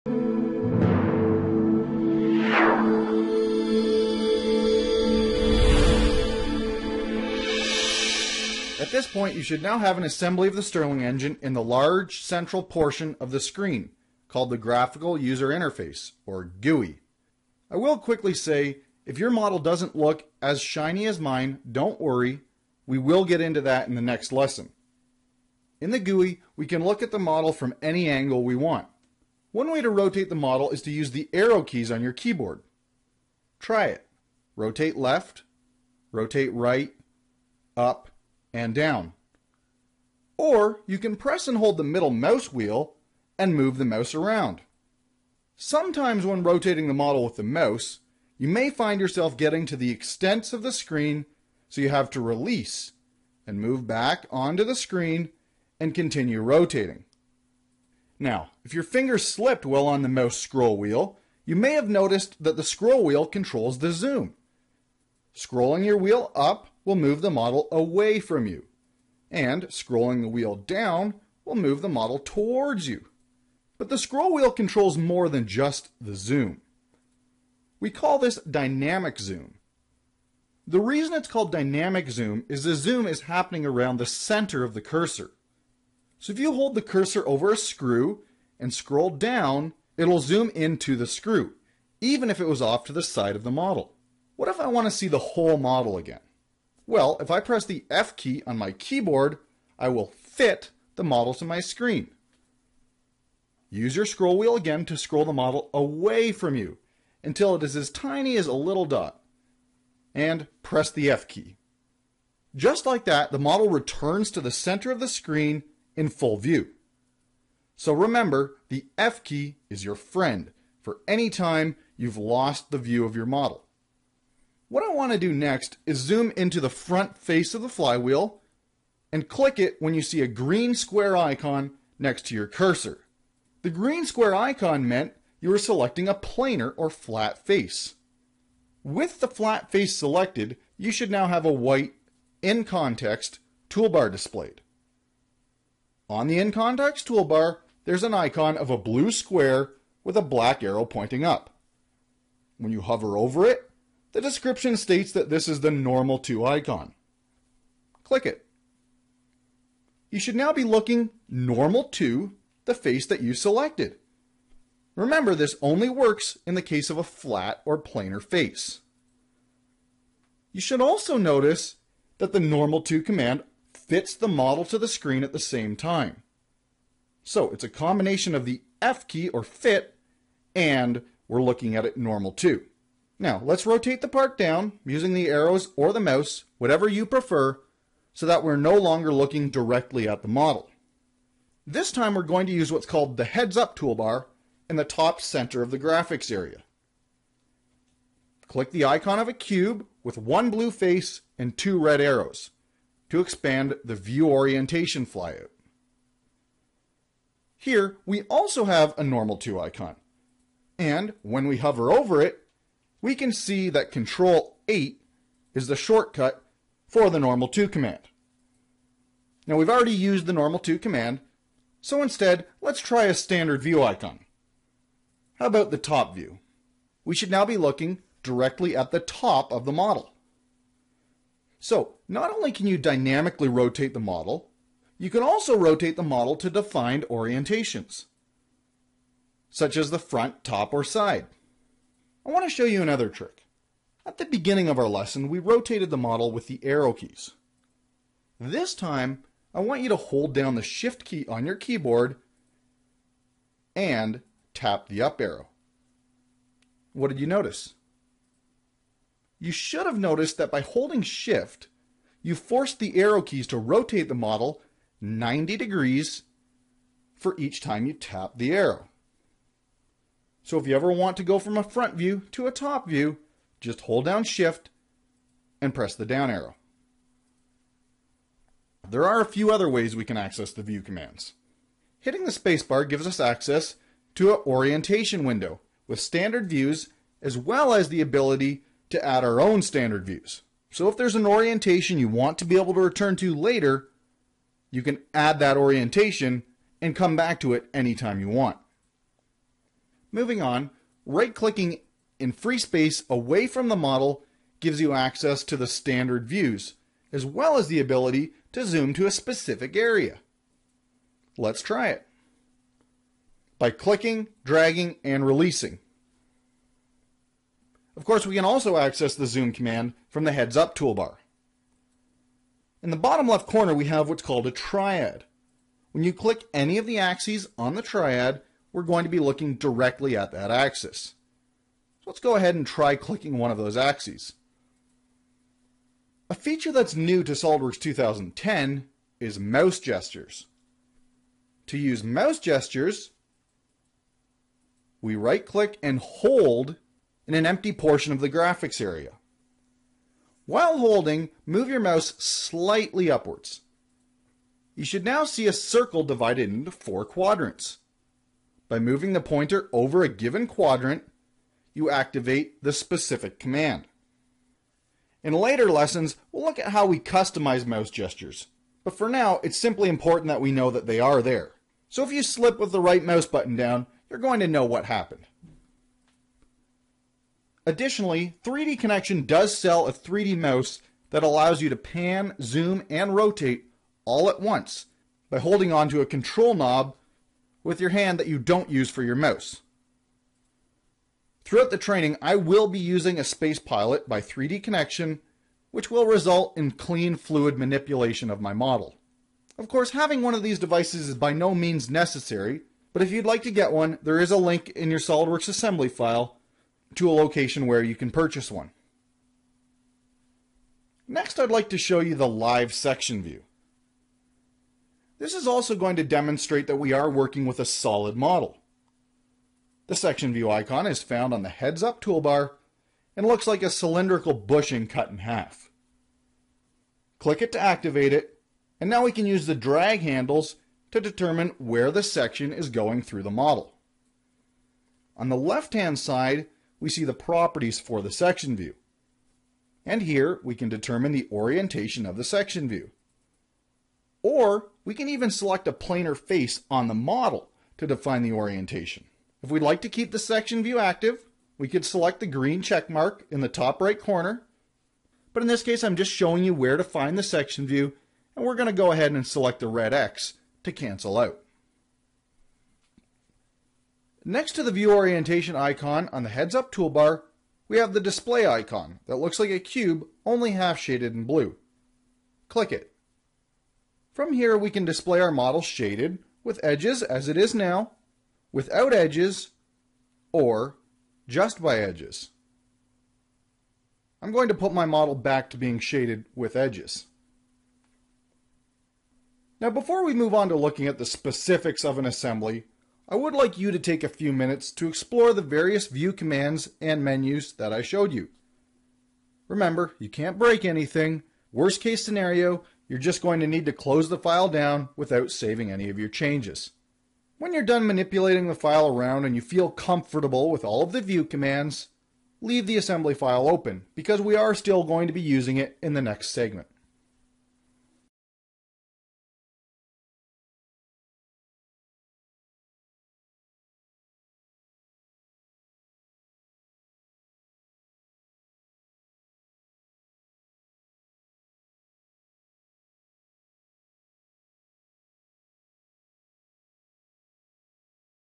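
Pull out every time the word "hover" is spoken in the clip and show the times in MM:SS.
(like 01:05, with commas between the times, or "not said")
02:32, 03:31.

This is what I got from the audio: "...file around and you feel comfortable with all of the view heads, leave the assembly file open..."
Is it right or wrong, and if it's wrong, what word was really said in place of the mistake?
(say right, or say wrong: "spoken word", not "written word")
wrong: "commands", not "heads".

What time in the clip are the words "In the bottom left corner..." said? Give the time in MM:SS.
05:22.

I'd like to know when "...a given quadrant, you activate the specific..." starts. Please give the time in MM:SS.
06:00.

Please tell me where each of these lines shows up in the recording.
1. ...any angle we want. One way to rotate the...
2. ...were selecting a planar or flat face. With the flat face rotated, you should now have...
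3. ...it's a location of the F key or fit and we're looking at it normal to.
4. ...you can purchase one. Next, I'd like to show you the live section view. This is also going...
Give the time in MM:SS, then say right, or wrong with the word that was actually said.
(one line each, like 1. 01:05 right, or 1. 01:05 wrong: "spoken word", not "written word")
1. 00:27 right
2. 02:15 wrong: "selected", not "rotated"
3. 02:57 wrong: "combination", not "location"
4. 06:47 right.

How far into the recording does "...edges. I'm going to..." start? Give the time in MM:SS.
08:01.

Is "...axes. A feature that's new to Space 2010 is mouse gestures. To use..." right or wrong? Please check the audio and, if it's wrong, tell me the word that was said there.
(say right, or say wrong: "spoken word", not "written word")
wrong: "SOLIDWORKS", not "Space".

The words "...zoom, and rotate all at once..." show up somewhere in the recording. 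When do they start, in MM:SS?
06:22.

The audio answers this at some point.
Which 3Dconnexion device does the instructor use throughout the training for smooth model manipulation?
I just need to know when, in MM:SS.
06:33.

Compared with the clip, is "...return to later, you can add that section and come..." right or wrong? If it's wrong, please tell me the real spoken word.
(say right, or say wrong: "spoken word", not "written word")
wrong: "orientation", not "section".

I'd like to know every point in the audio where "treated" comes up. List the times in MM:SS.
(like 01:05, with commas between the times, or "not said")
not said.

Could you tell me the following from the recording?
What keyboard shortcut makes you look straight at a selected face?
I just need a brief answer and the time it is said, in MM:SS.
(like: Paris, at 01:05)
Control 8, at 03:33.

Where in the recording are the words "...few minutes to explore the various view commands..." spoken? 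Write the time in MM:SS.
08:14.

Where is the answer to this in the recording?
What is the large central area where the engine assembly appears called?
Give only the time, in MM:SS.
00:14.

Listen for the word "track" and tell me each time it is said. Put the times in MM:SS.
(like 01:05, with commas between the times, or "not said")
not said.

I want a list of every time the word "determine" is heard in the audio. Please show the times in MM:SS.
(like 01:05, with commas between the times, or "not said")
07:10, 07:20.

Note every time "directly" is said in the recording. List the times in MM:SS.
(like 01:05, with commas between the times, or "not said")
03:09, 03:48, 05:29.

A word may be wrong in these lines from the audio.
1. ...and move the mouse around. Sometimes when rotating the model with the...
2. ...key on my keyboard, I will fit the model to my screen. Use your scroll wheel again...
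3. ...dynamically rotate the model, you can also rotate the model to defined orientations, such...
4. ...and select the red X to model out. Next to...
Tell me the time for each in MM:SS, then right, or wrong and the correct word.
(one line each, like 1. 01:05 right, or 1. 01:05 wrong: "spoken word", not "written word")
1. 00:43 right
2. 01:38 right
3. 03:52 right
4. 07:39 wrong: "cancel", not "model".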